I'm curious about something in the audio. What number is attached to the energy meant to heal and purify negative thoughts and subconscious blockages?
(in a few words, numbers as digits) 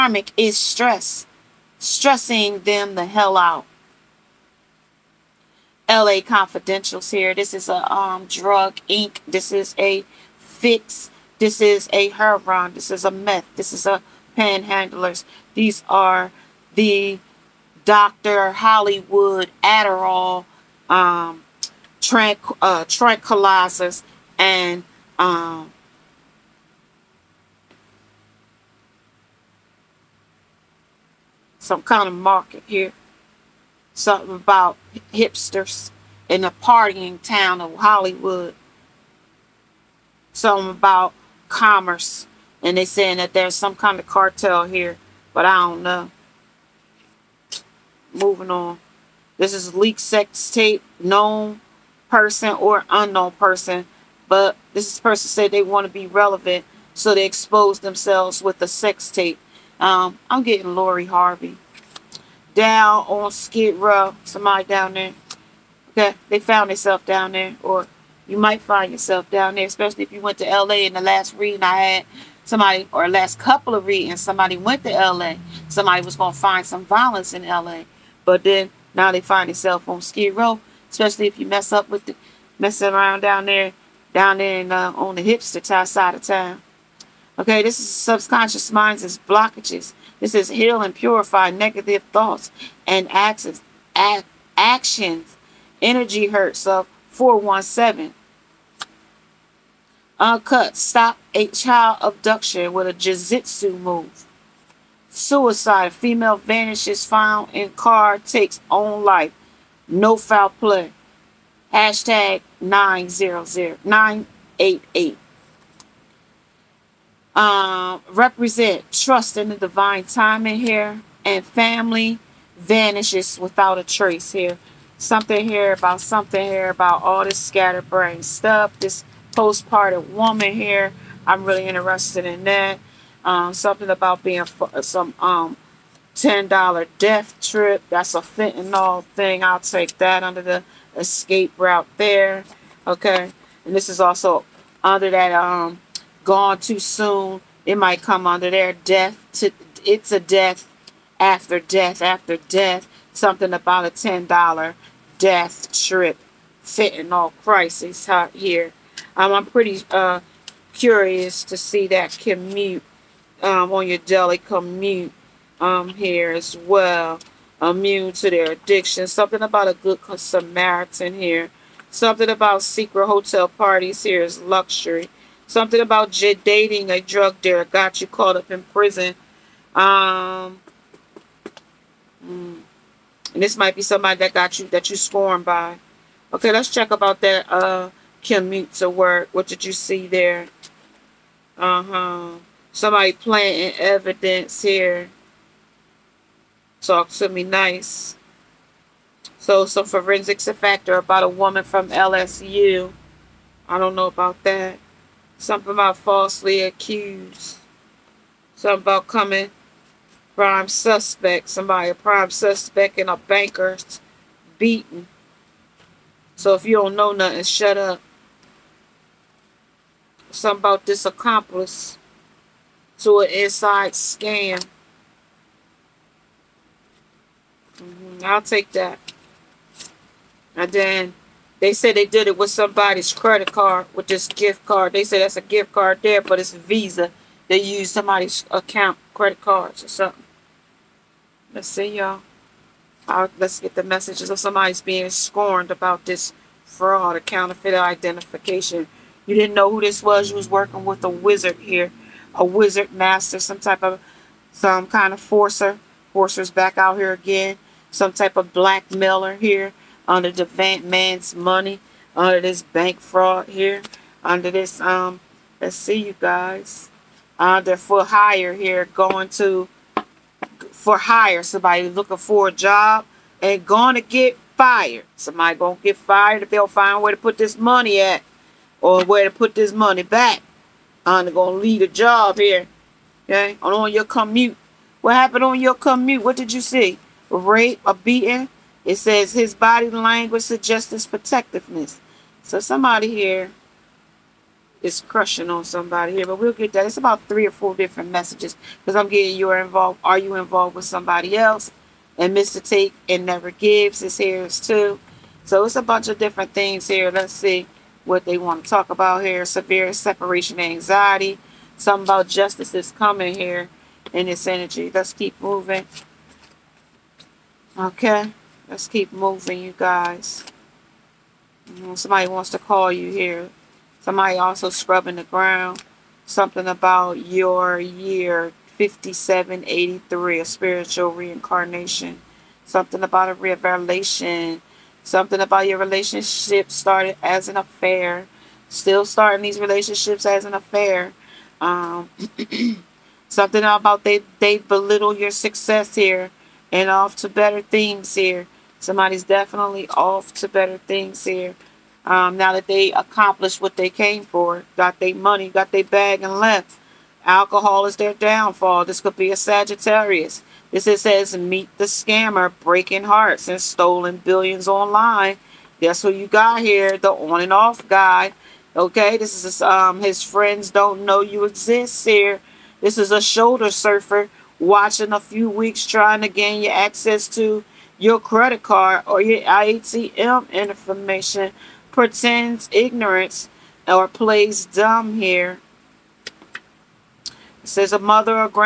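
417.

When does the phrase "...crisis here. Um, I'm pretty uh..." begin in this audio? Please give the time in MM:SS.
02:37.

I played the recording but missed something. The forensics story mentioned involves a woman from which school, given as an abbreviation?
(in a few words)
LSU.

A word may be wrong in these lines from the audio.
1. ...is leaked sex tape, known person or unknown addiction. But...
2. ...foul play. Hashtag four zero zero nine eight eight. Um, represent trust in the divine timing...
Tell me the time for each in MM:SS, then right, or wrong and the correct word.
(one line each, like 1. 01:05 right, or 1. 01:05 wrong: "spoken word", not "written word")
1. 00:49 wrong: "person", not "addiction"
2. 01:50 wrong: "nine", not "four".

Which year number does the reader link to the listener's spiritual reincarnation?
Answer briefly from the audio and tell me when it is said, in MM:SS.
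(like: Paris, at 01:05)
5783, at 05:28.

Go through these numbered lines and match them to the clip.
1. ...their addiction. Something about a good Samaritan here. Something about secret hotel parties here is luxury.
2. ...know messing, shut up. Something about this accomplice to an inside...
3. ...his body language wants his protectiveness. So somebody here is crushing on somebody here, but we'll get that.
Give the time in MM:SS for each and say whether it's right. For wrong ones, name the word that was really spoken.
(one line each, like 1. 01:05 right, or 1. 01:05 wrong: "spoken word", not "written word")
1. 02:48 right
2. 03:36 wrong: "nothing", not "messing"
3. 04:49 wrong: "suggests", not "wants".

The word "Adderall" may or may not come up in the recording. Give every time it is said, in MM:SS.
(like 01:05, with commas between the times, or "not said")
00:19.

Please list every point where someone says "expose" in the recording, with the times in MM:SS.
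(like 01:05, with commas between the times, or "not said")
00:57.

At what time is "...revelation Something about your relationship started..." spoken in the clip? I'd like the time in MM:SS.
05:33.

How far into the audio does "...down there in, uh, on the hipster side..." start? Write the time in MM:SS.
01:24.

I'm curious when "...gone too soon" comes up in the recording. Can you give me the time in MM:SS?
02:26.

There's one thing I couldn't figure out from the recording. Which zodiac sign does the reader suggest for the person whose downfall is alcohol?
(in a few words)
Sagittarius.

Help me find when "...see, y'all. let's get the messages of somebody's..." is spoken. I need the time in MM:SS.
04:01.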